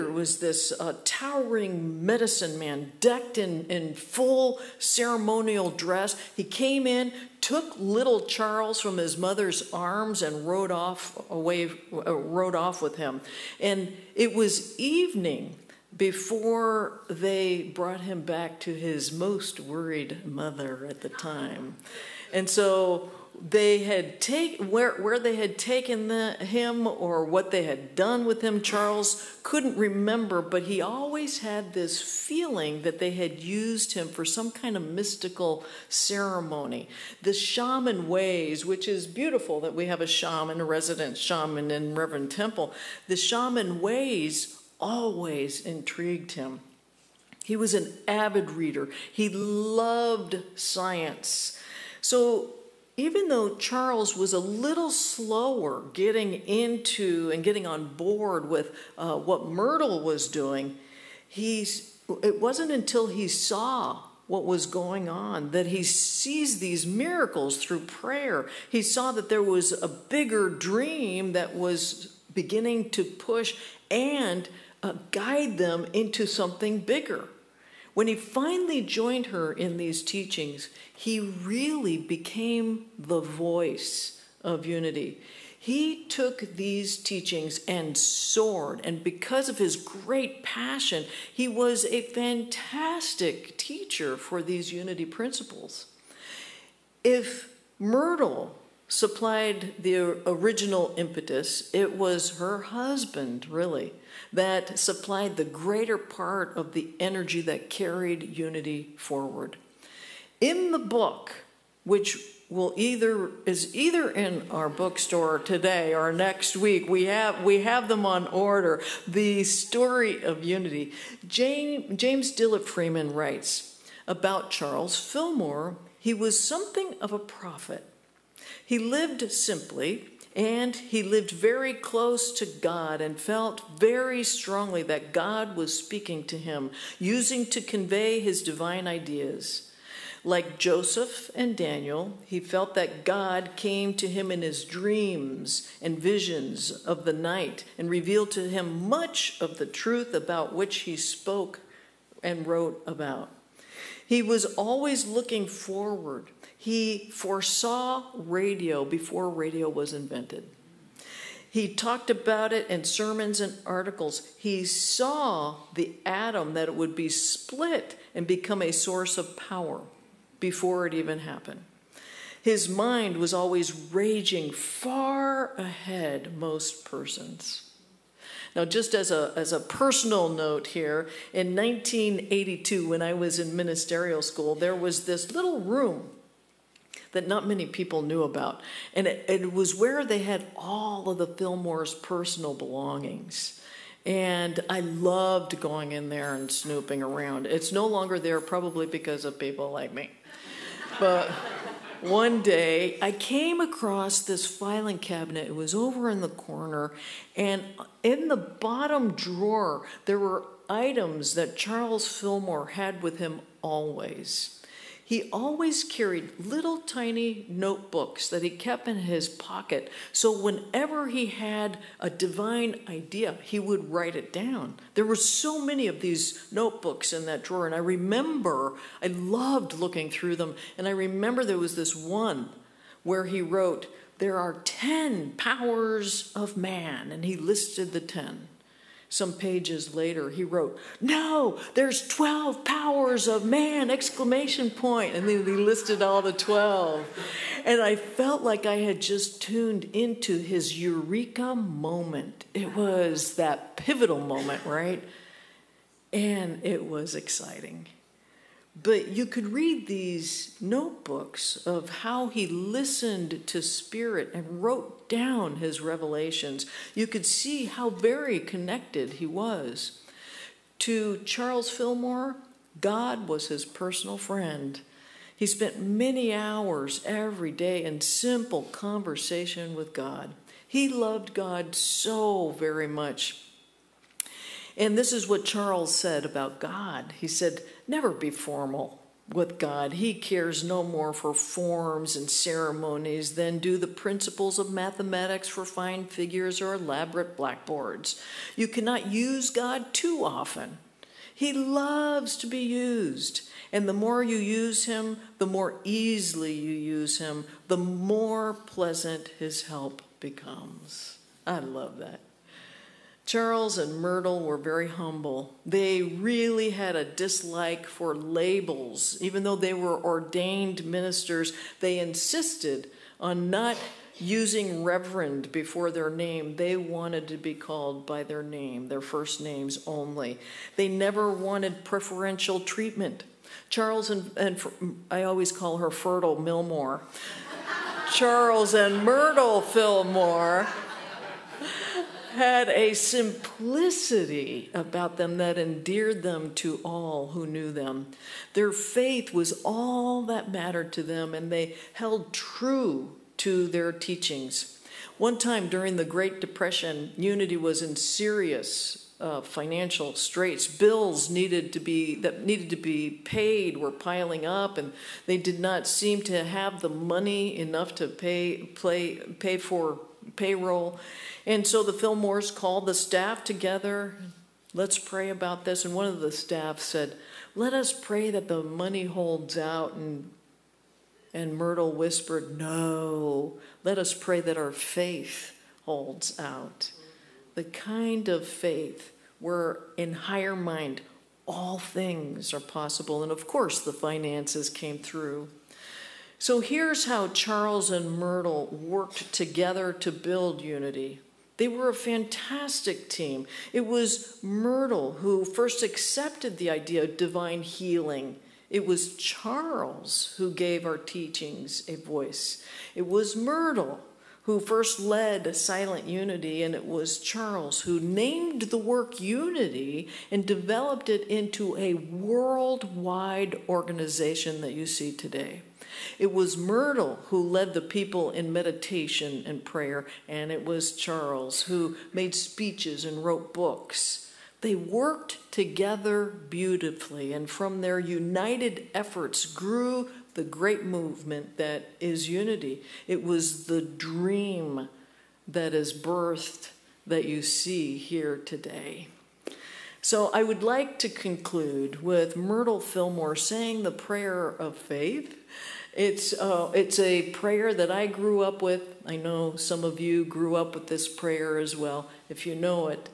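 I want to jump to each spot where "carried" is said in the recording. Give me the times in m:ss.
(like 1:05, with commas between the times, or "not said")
1:47, 3:35.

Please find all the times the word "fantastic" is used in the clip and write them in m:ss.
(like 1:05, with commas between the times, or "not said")
1:32, 6:41.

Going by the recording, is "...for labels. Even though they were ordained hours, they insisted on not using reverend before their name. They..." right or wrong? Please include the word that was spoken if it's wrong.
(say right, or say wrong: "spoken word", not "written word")
wrong: "ministers", not "hours".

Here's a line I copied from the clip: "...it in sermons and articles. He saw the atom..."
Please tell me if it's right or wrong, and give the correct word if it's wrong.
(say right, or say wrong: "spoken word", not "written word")
right.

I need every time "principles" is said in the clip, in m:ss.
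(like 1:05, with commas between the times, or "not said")
1:35, 4:53.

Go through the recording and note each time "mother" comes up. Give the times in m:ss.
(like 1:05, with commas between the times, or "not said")
0:09, 0:20.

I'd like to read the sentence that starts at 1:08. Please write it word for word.
He saw that there was a bigger dream that was beginning to push and uh, guide them into something bigger.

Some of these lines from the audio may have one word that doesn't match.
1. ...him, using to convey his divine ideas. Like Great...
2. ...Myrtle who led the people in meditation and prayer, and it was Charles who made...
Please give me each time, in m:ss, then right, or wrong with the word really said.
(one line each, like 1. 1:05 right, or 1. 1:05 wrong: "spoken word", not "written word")
1. 2:16 wrong: "Joseph", not "Great"
2. 7:06 right.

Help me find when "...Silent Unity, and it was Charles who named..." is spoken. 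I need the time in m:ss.
6:55.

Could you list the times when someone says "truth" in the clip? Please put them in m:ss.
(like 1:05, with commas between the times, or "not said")
2:29.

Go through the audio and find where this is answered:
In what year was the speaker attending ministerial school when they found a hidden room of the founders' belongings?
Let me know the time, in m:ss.
3:01.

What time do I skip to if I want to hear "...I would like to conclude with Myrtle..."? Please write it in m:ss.
7:30.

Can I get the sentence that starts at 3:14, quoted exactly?
And I loved going in there and snooping around.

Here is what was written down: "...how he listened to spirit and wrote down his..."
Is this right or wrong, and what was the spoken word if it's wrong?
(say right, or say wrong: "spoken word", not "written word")
right.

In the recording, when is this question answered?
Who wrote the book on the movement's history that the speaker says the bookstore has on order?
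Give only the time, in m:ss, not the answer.
2:01.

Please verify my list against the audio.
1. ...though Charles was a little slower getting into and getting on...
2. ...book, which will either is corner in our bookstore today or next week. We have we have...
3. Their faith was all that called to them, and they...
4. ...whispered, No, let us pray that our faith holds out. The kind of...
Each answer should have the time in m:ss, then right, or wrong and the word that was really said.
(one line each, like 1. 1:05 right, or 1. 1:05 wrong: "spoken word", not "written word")
1. 0:53 right
2. 1:50 wrong: "either", not "corner"
3. 5:48 wrong: "mattered", not "called"
4. 6:21 right.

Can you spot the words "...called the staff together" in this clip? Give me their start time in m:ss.
6:12.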